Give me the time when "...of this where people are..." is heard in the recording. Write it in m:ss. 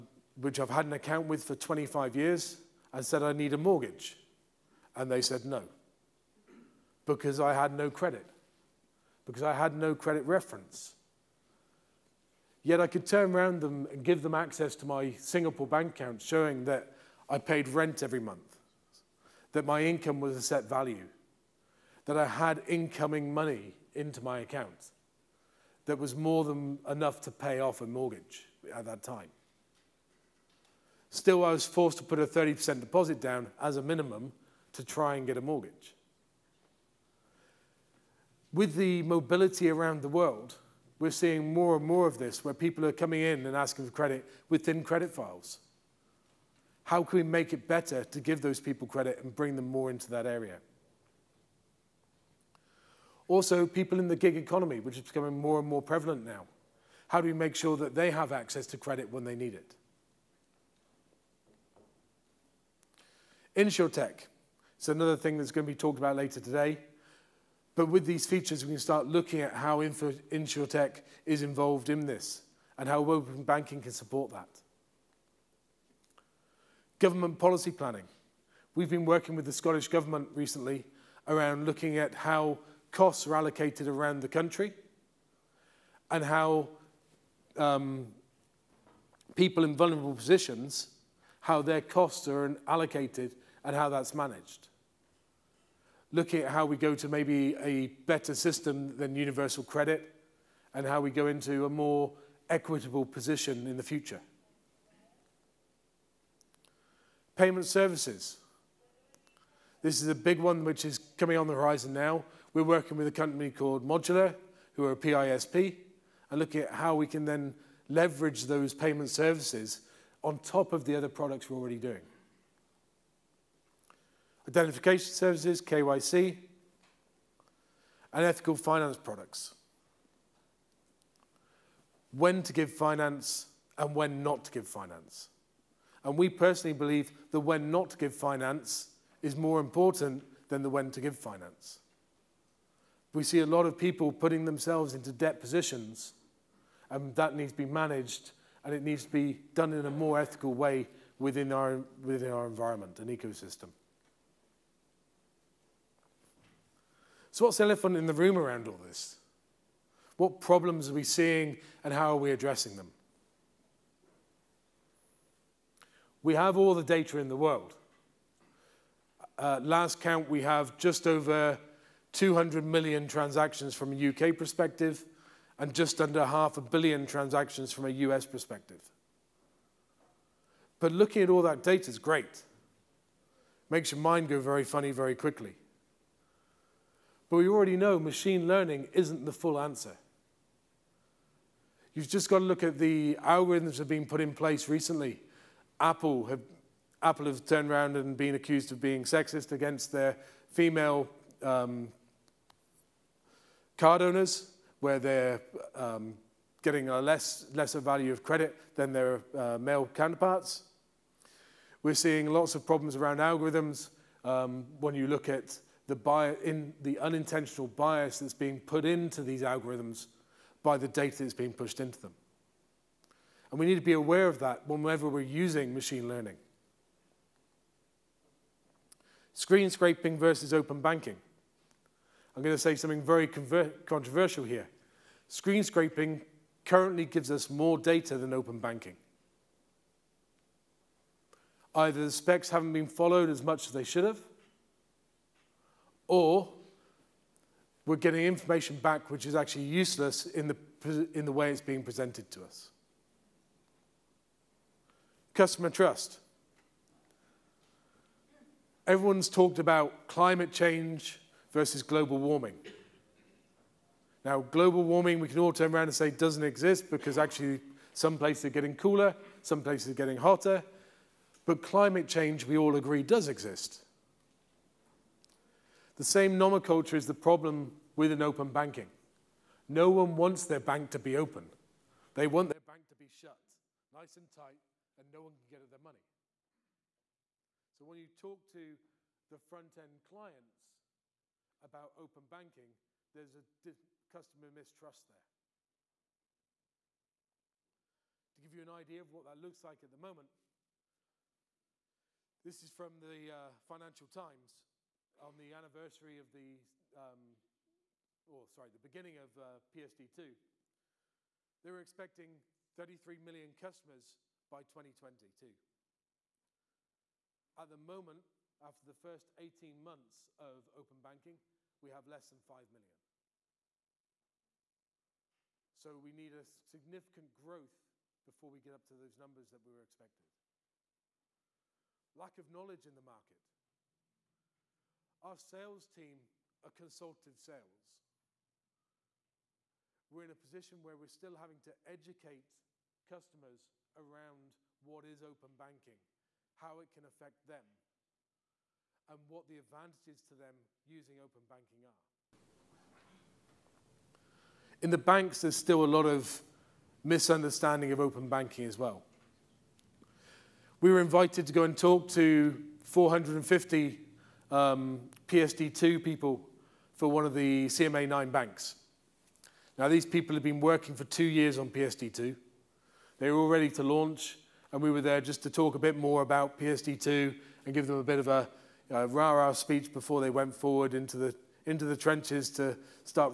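0:42.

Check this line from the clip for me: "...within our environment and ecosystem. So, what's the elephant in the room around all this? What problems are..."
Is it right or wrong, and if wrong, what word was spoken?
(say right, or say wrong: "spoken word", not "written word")
right.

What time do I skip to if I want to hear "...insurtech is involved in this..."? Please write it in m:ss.
1:09.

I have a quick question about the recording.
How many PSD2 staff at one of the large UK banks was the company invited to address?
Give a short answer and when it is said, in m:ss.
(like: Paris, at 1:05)
450, at 6:02.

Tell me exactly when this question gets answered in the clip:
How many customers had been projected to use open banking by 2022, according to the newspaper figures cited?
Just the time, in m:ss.
5:12.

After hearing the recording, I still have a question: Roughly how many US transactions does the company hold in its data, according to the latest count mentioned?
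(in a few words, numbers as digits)
just under half a billion.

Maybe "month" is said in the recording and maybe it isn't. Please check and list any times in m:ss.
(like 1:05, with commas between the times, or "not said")
0:18, 5:19.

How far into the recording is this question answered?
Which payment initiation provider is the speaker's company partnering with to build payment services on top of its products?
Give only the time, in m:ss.
1:53.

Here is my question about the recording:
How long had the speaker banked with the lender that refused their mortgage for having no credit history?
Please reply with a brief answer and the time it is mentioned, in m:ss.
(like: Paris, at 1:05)
25 years, at 0:01.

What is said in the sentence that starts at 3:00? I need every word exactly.
But looking at all that data is great.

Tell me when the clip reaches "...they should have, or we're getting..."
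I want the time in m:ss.
4:03.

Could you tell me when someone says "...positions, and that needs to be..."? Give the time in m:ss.
2:25.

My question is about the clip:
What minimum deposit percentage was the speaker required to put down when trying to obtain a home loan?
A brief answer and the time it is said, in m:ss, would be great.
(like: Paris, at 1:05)
30%, at 0:32.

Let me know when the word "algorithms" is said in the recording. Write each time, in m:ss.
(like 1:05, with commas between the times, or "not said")
3:13, 3:33, 3:39.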